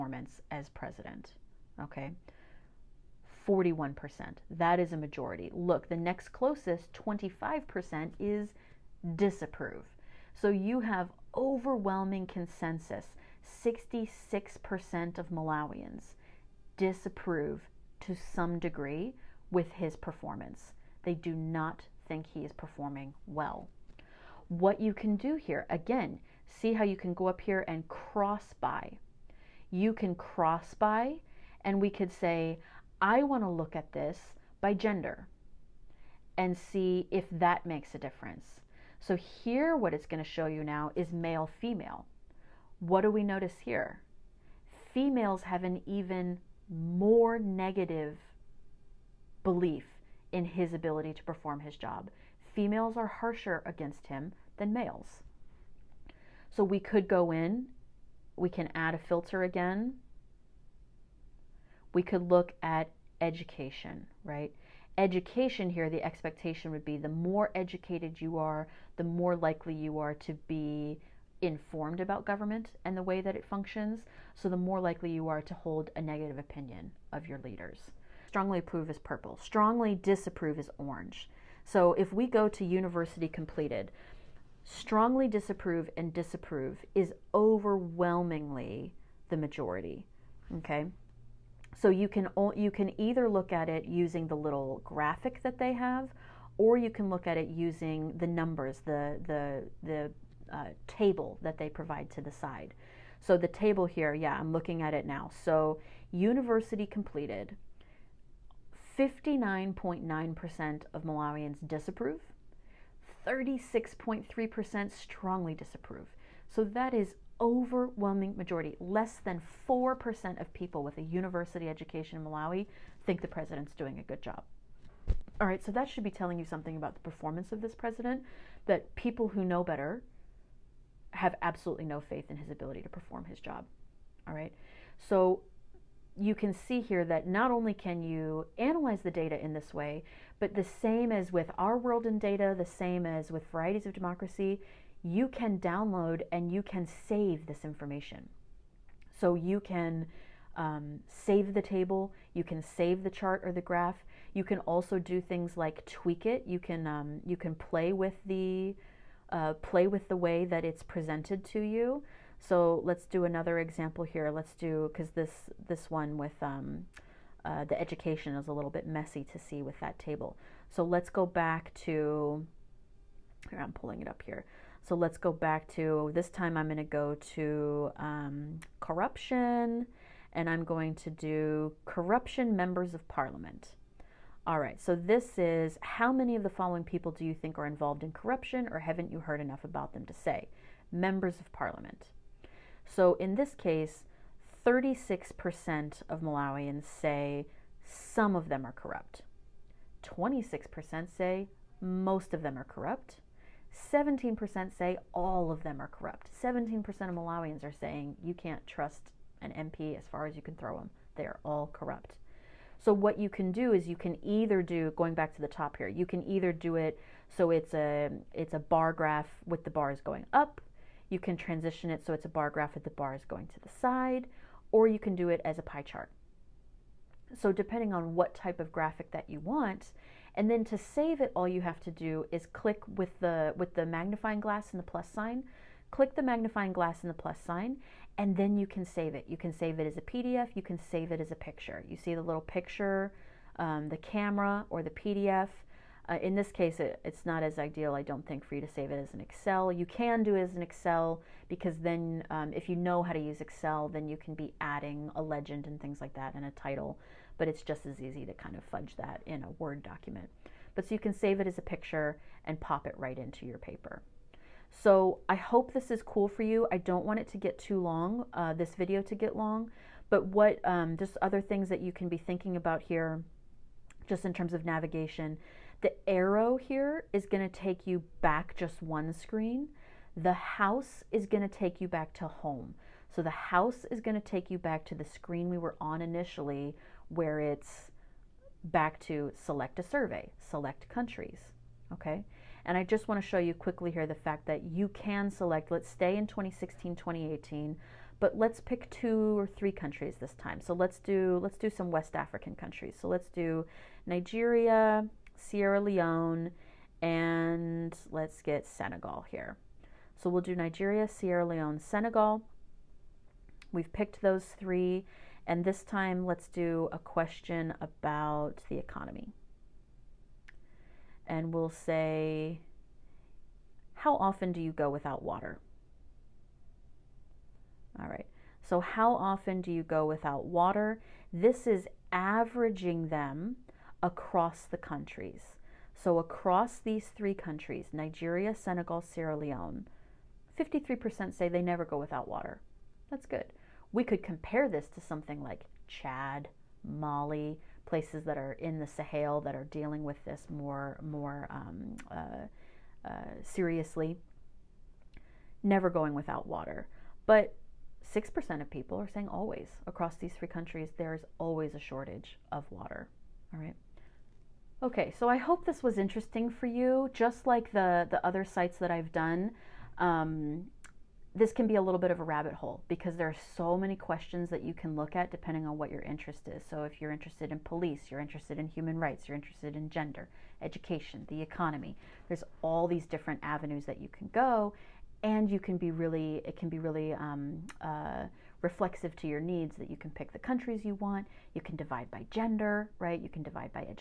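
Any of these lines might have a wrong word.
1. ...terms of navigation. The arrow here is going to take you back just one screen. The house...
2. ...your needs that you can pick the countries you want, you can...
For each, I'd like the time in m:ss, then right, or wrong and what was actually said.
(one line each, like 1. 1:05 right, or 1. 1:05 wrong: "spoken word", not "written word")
1. 4:34 right
2. 6:29 right.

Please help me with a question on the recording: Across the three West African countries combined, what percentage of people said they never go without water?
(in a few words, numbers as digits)
53%.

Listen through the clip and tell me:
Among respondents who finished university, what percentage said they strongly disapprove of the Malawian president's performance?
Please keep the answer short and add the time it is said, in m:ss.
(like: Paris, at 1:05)
36.3%, at 1:53.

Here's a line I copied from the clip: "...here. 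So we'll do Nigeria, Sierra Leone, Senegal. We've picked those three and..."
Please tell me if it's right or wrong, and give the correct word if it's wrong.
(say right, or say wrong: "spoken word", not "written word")
right.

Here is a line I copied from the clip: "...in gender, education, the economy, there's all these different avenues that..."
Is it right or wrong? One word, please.
right.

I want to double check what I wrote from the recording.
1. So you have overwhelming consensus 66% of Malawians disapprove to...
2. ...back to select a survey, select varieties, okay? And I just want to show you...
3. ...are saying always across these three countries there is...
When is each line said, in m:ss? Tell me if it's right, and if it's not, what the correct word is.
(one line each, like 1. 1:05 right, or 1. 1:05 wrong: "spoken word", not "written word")
1. 0:10 right
2. 4:48 wrong: "countries", not "varieties"
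3. 5:58 right.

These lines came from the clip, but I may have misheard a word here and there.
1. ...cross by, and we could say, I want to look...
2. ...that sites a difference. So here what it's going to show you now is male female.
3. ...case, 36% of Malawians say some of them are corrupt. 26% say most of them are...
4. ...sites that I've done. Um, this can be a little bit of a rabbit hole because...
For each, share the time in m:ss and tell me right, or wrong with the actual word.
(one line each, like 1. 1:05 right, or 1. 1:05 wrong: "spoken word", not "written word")
1. 0:30 right
2. 0:37 wrong: "makes", not "sites"
3. 3:13 right
4. 6:08 right.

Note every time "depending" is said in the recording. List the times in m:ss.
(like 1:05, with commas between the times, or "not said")
3:47, 6:15.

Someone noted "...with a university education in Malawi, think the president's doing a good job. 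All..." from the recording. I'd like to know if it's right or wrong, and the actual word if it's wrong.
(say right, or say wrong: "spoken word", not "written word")
right.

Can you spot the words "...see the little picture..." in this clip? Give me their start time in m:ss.
4:01.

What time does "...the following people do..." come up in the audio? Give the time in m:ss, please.
3:06.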